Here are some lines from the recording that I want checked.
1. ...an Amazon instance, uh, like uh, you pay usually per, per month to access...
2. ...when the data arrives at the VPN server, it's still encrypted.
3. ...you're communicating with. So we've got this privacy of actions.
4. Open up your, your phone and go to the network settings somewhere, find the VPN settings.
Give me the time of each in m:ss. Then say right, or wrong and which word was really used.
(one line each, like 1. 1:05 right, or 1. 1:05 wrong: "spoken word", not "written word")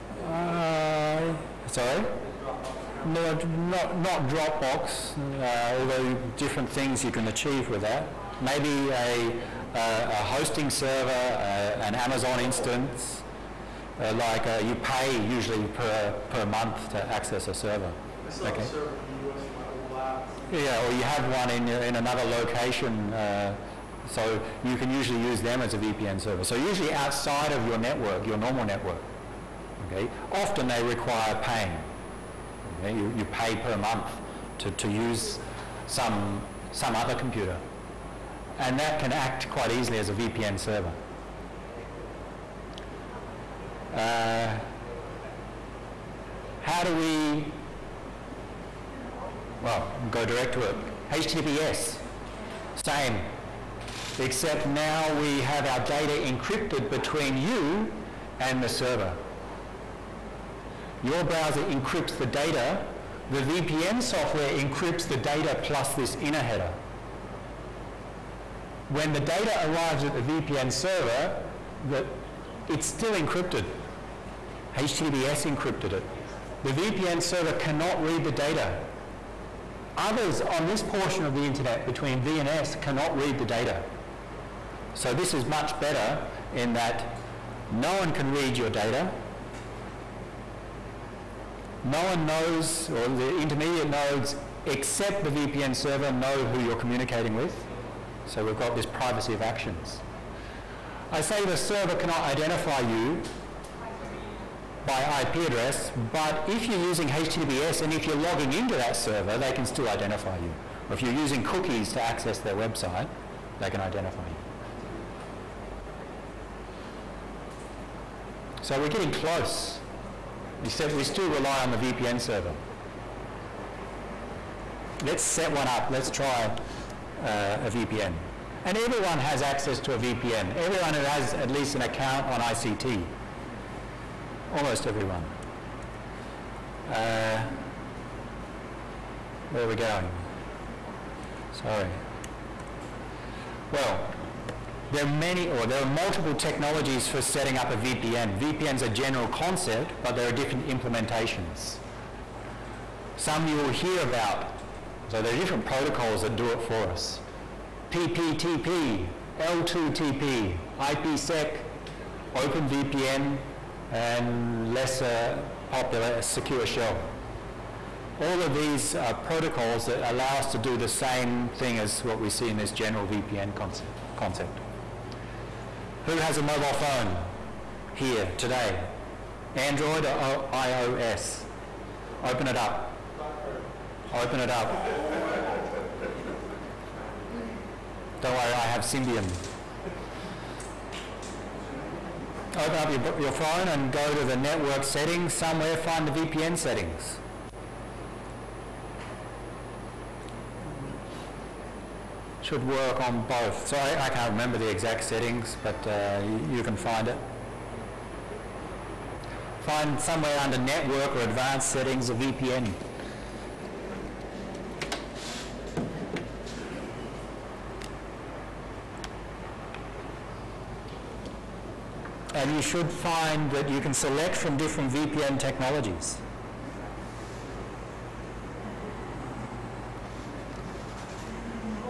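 1. 0:11 right
2. 1:08 right
3. 1:36 right
4. 3:12 right.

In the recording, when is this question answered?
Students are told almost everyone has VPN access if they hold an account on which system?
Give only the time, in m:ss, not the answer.
2:12.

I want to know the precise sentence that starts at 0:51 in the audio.
HTTPS, same, except now we have our data encrypted between you and the server.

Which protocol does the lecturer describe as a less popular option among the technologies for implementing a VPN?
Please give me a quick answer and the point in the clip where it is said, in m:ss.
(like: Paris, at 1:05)
Secure Shell, at 2:46.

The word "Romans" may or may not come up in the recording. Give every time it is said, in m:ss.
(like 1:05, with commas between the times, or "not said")
not said.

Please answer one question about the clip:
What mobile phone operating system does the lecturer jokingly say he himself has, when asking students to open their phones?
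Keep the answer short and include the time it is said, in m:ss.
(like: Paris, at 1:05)
Symbian, at 3:08.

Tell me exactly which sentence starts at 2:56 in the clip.
Who has a mobile phone here today?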